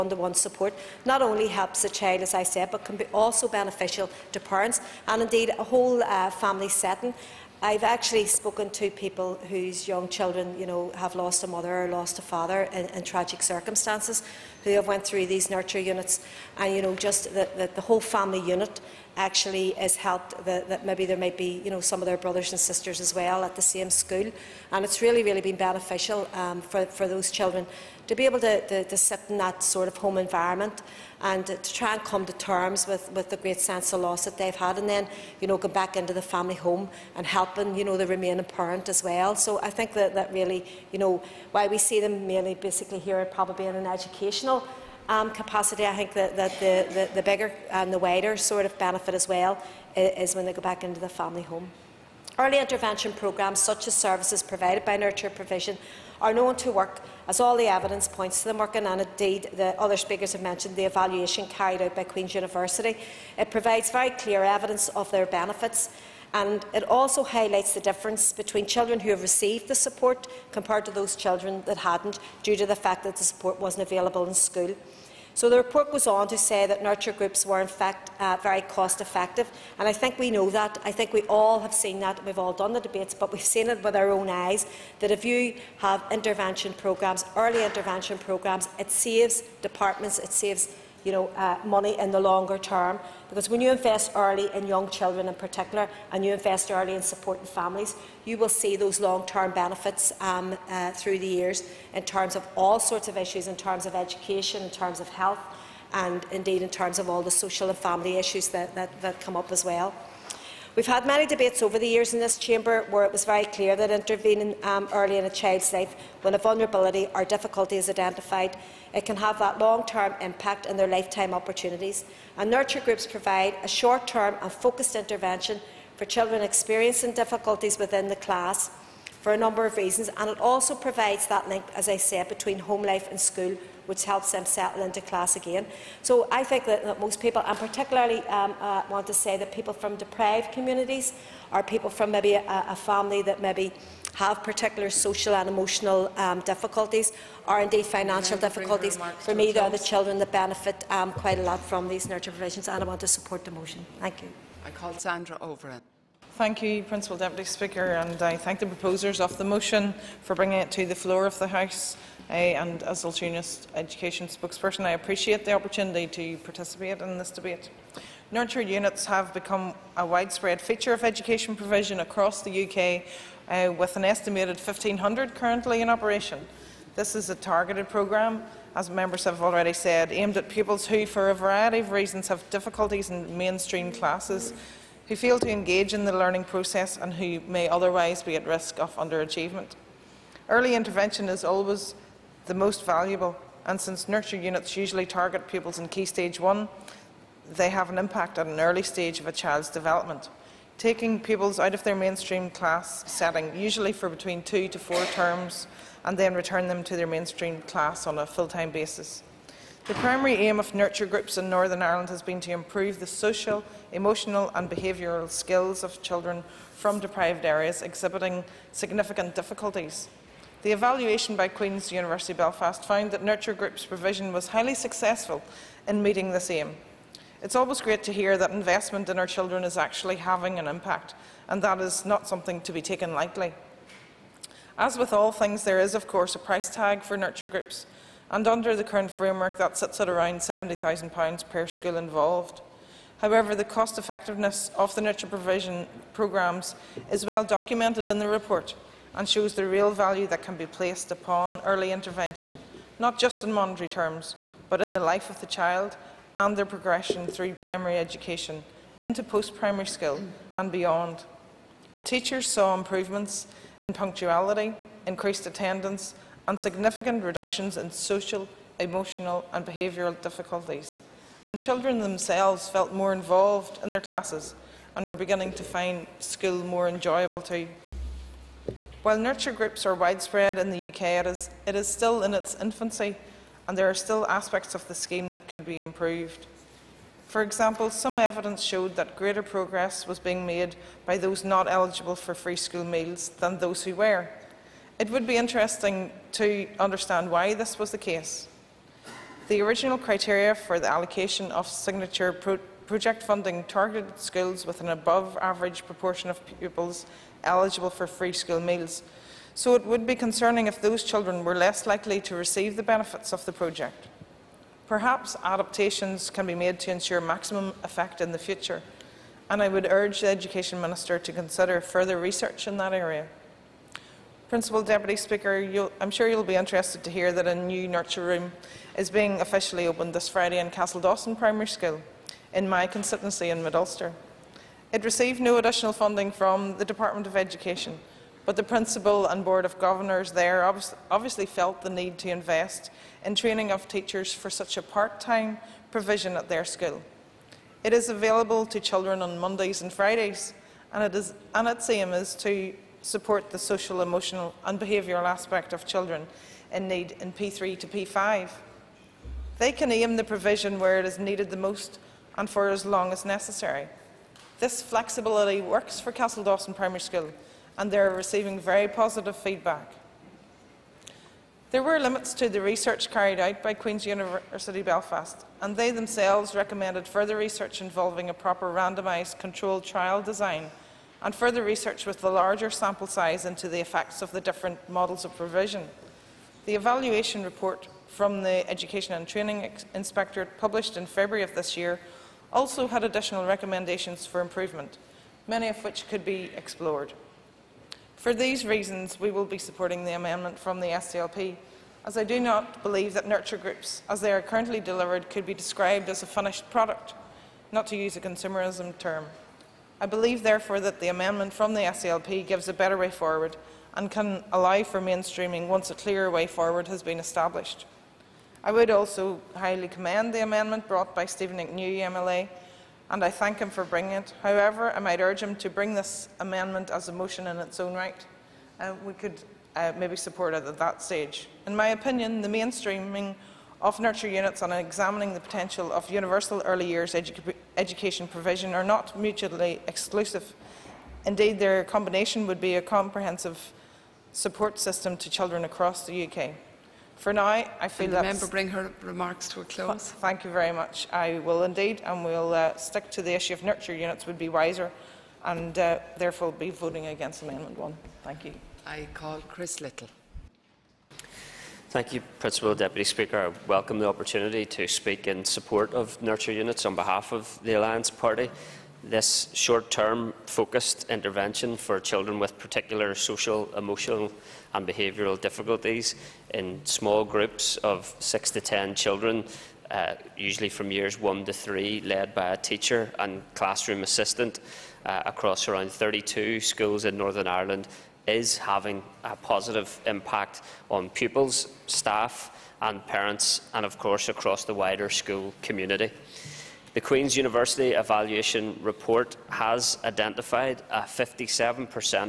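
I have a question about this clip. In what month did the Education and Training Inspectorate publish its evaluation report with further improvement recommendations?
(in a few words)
February.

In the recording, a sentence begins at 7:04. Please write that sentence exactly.
However, I might urge him to bring this amendment as a motion in its own right.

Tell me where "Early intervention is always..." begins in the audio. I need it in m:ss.
3:10.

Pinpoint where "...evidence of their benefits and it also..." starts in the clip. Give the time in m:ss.
1:04.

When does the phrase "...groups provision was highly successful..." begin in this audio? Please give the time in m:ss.
3:43.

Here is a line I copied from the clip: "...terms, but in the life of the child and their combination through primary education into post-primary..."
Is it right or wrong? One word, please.
wrong.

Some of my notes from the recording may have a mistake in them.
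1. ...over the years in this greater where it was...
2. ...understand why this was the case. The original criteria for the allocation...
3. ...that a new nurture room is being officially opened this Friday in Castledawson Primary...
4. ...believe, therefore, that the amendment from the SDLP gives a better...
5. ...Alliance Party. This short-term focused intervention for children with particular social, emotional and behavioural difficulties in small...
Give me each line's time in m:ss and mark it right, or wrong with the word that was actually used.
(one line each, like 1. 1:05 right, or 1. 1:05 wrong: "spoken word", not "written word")
1. 1:51 wrong: "chamber", not "greater"
2. 4:56 right
3. 5:27 right
4. 6:50 right
5. 7:47 right.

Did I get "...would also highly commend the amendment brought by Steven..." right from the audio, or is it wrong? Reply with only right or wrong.
right.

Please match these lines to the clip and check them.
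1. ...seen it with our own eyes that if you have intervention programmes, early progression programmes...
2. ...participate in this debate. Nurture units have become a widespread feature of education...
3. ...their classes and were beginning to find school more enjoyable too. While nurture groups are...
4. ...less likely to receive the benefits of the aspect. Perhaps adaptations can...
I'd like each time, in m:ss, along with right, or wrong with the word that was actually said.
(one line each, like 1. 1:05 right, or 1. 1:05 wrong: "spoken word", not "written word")
1. 1:23 wrong: "intervention", not "progression"
2. 2:46 right
3. 4:33 right
4. 5:11 wrong: "project", not "aspect".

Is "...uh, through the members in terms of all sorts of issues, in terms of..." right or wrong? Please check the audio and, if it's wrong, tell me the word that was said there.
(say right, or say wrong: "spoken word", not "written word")
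wrong: "years", not "members".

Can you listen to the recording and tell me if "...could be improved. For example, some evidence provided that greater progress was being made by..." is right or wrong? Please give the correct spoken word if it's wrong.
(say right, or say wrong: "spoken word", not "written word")
wrong: "showed", not "provided".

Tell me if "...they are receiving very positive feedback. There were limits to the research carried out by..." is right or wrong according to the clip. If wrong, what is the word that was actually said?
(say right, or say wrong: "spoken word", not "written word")
right.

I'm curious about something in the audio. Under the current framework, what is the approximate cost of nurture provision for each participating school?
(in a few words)
£70,000.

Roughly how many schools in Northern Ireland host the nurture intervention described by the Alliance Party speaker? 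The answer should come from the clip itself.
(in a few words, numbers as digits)
32.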